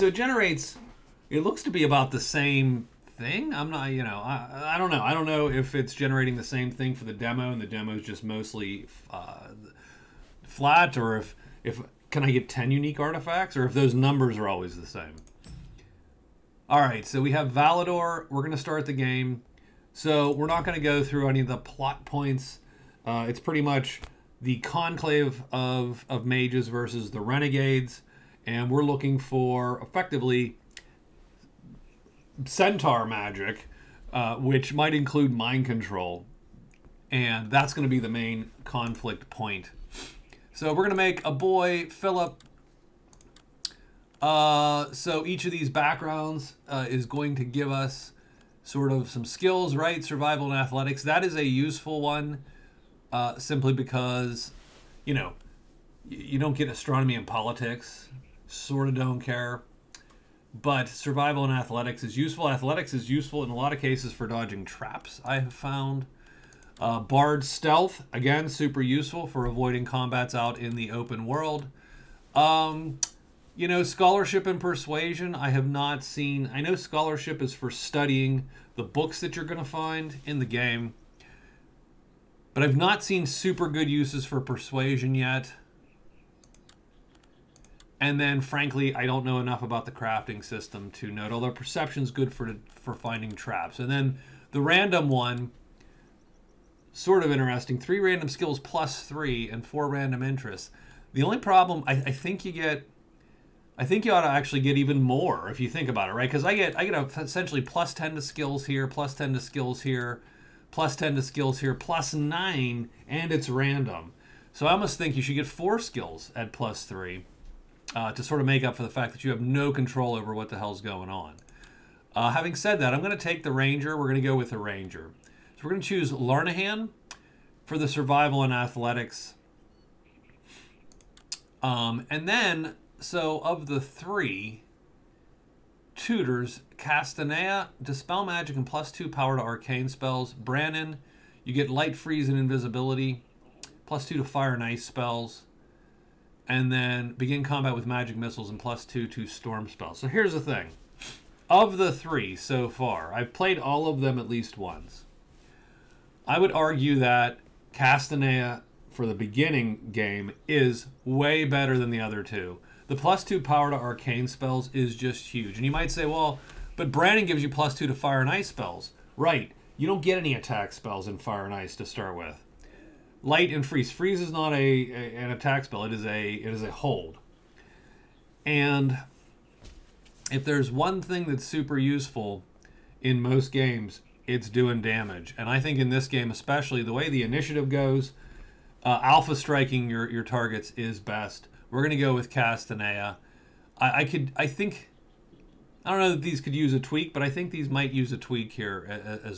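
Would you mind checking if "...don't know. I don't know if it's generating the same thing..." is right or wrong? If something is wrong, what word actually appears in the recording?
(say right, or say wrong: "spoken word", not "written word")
right.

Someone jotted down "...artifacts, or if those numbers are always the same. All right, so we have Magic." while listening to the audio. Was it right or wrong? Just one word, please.
wrong.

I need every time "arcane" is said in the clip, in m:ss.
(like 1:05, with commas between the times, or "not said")
2:19, 2:43.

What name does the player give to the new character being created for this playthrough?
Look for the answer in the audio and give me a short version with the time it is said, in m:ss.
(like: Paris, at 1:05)
Philip, at 0:41.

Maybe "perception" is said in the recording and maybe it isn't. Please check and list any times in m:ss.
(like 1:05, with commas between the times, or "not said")
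1:31.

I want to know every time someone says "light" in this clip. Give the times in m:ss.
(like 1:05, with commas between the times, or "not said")
2:21, 2:53.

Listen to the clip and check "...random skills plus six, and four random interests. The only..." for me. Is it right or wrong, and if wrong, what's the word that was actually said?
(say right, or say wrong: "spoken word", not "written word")
wrong: "three", not "six".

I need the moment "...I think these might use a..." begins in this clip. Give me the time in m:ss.
3:17.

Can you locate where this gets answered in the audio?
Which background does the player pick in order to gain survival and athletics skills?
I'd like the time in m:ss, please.
2:06.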